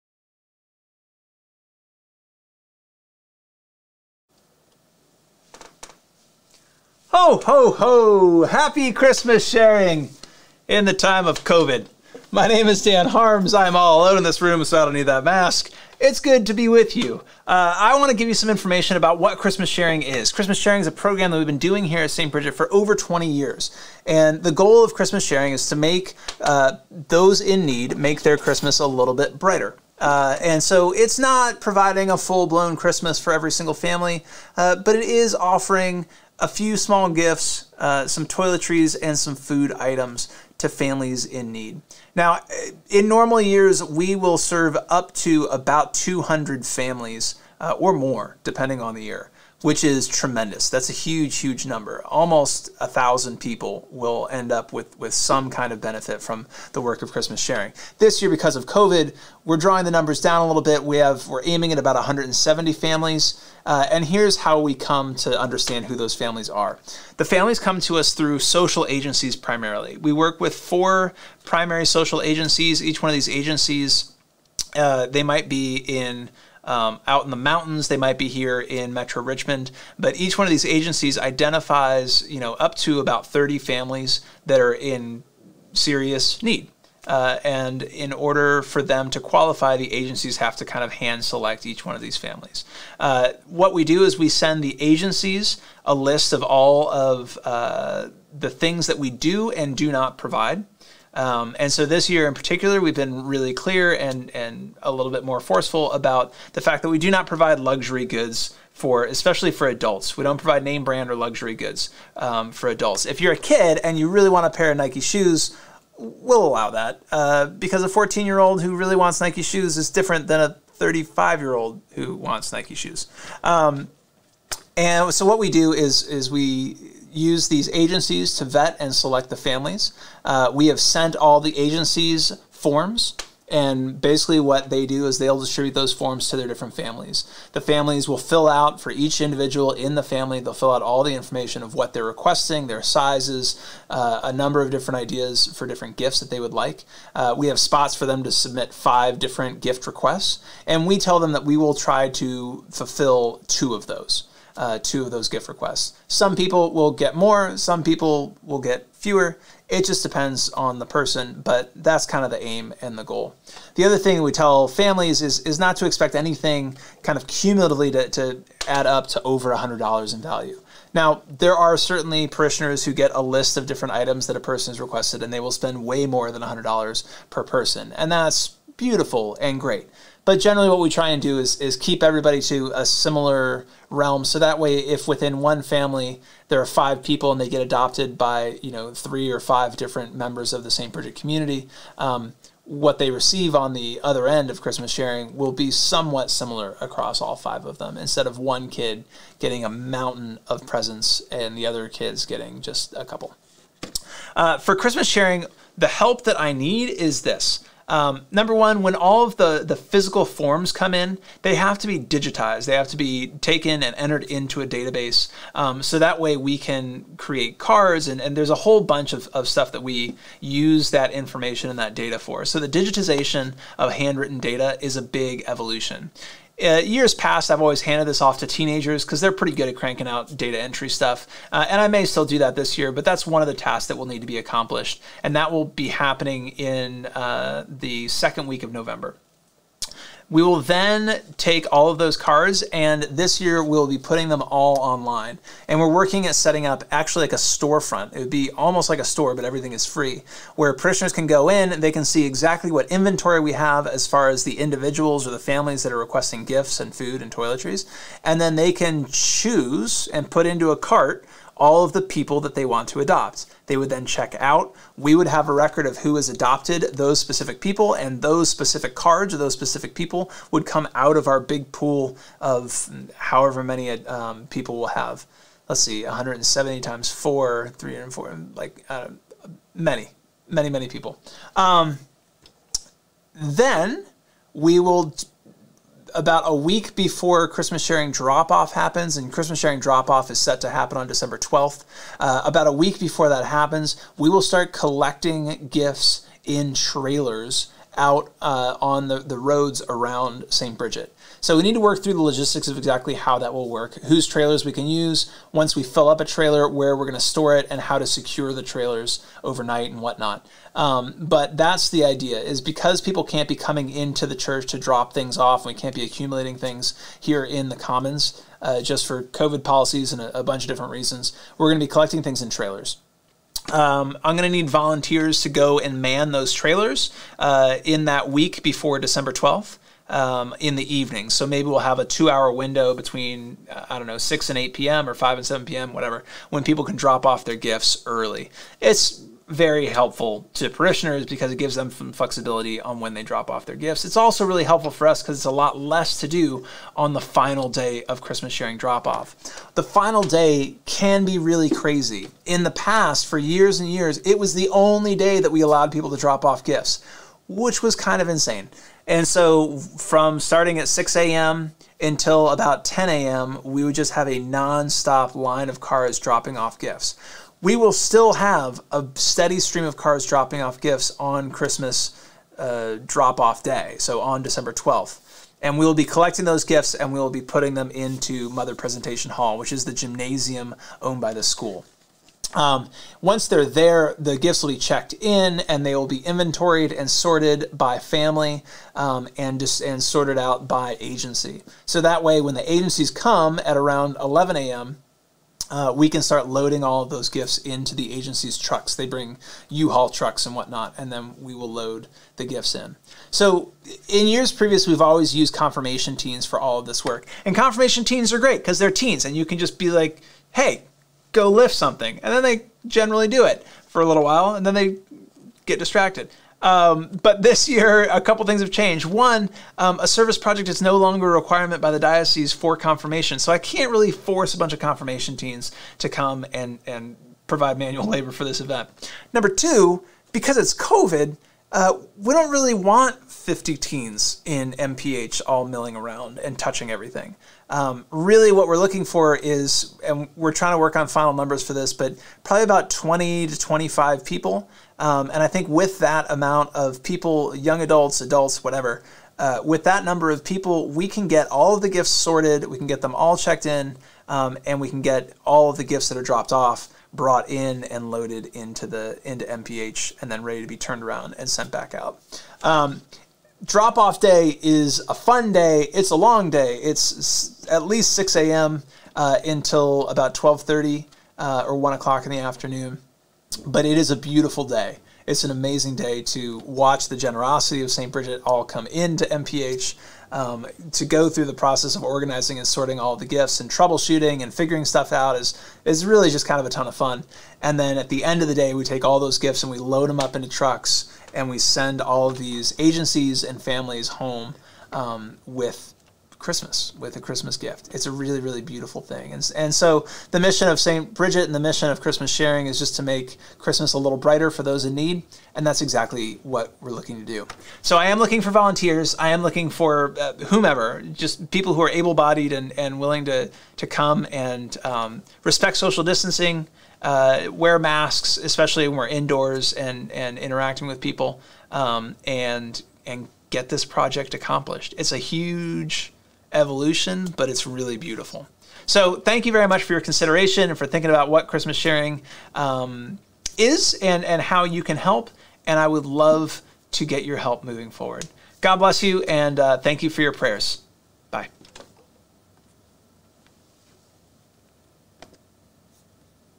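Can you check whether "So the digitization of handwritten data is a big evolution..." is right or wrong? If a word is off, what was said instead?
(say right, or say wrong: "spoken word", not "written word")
right.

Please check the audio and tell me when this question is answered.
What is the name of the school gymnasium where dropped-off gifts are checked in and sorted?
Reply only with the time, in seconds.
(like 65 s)
378 s.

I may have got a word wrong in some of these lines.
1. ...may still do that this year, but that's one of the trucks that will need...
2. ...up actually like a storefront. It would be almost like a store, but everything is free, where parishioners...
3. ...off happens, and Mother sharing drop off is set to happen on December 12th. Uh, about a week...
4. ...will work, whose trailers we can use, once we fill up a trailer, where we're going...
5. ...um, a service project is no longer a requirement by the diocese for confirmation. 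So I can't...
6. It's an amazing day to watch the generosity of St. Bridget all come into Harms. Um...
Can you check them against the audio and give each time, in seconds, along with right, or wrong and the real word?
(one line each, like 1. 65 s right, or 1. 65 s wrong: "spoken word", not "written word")
1. 231 s wrong: "tasks", not "trucks"
2. 246 s right
3. 288 s wrong: "Christmas", not "Mother"
4. 303 s right
5. 419 s right
6. 475 s wrong: "MPH", not "Harms".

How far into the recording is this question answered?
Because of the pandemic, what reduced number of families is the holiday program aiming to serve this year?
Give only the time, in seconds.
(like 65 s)
61 s.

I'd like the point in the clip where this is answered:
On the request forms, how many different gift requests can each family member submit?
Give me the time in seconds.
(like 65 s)
148 s.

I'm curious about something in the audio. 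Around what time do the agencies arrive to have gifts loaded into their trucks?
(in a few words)
11 a.m.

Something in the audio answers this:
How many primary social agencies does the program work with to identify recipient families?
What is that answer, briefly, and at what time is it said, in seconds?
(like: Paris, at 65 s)
4, at 70 s.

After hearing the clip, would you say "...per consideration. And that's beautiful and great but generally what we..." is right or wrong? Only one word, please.
wrong.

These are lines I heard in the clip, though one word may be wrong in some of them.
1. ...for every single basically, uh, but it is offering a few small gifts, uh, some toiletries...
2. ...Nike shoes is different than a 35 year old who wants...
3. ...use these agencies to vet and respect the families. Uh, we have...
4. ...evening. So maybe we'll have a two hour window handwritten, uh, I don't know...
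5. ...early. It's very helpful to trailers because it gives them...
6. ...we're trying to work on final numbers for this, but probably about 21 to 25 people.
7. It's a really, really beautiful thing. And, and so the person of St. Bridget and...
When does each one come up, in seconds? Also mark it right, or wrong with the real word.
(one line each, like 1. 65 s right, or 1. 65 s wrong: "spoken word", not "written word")
1. 33 s wrong: "family", not "basically"
2. 119 s right
3. 127 s wrong: "select", not "respect"
4. 330 s wrong: "between", not "handwritten"
5. 338 s wrong: "parishioners", not "trailers"
6. 440 s wrong: "20", not "21"
7. 497 s wrong: "mission", not "person".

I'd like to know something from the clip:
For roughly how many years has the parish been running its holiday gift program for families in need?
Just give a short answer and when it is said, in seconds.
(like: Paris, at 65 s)
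Over 20 years, at 22 s.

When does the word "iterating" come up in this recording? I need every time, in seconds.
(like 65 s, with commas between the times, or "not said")
not said.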